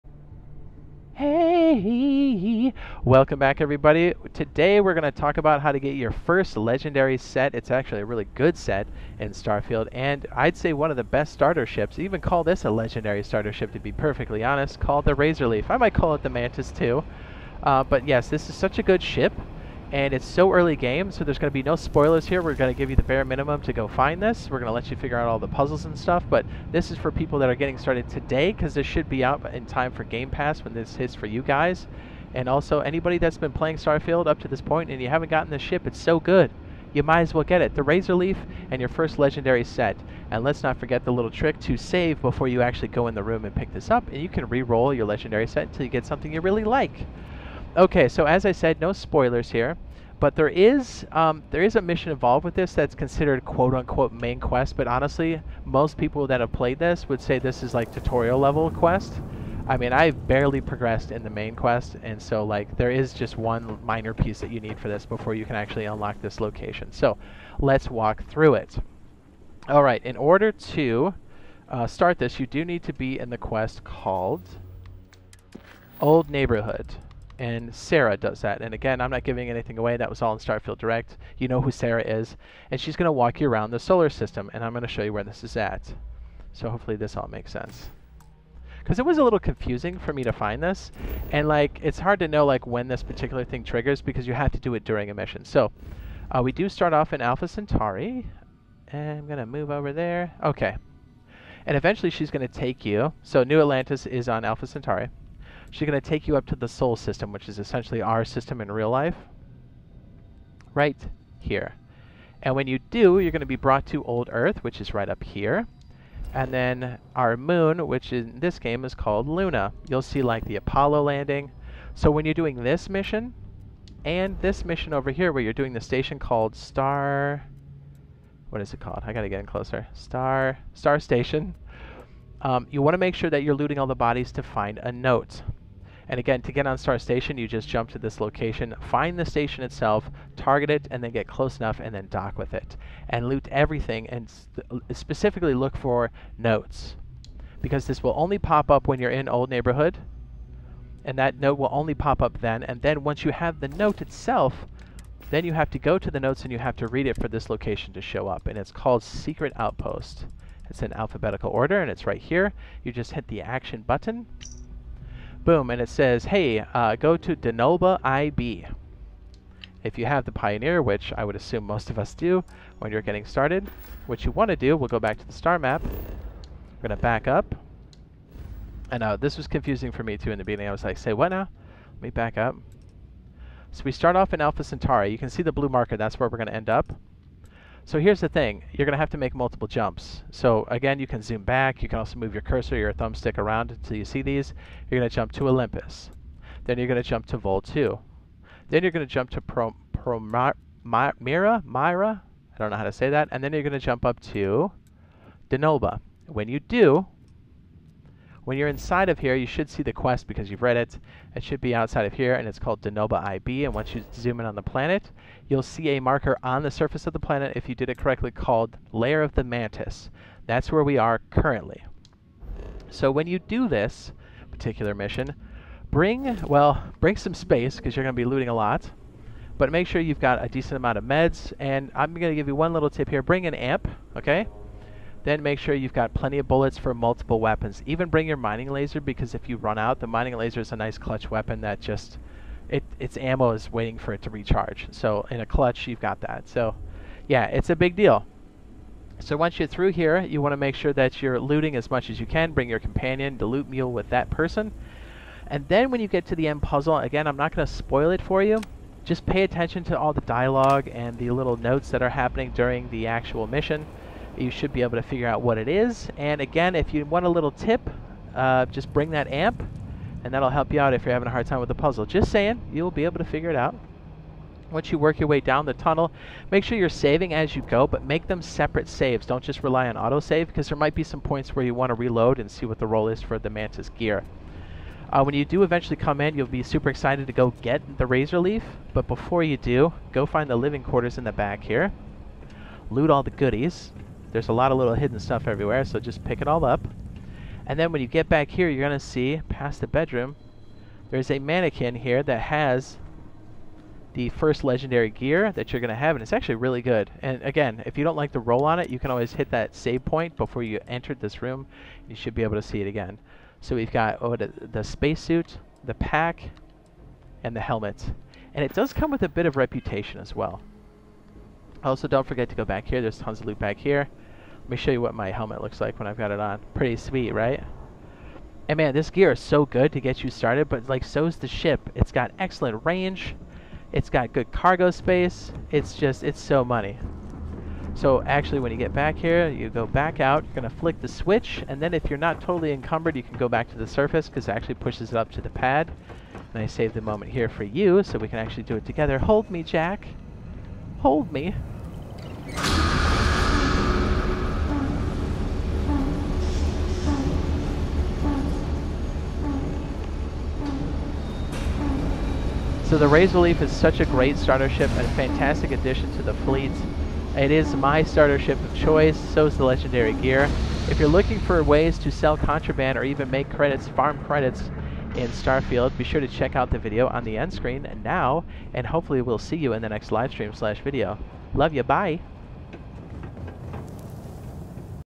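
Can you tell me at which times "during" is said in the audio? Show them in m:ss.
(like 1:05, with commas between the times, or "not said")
1:34, 4:22.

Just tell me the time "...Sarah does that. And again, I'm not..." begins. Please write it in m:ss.
1:17.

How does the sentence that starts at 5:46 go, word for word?
And I saved the moment here for you so we can actually do it together.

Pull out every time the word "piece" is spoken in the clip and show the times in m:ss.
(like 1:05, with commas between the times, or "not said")
1:04.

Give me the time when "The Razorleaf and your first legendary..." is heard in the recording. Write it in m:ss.
0:37.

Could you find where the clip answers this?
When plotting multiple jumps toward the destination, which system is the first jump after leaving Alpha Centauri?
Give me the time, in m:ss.
3:15.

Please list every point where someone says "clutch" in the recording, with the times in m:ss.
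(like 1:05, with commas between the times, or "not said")
4:00, 4:05.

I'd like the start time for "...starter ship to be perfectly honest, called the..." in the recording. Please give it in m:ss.
0:13.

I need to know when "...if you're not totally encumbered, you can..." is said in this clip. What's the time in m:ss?
5:41.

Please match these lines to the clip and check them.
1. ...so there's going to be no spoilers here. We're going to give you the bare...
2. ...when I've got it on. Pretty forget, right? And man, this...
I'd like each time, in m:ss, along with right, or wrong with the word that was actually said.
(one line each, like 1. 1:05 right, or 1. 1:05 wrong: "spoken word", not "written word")
1. 0:21 right
2. 5:25 wrong: "sweet", not "forget".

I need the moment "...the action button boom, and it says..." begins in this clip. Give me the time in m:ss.
2:43.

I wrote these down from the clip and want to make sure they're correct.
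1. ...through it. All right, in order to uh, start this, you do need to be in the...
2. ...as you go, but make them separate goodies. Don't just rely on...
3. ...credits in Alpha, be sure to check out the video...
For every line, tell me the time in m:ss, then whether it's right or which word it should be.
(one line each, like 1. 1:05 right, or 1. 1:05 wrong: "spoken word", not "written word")
1. 1:08 right
2. 4:37 wrong: "saves", not "goodies"
3. 6:14 wrong: "Starfield", not "Alpha".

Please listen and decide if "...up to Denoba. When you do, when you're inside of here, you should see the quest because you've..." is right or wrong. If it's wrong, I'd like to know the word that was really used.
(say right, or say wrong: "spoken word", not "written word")
right.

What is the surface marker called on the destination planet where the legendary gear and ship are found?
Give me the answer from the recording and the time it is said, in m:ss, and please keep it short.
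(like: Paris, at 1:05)
Lair of the Mantis, at 3:38.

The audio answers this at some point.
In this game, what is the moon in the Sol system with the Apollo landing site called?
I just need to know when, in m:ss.
1:59.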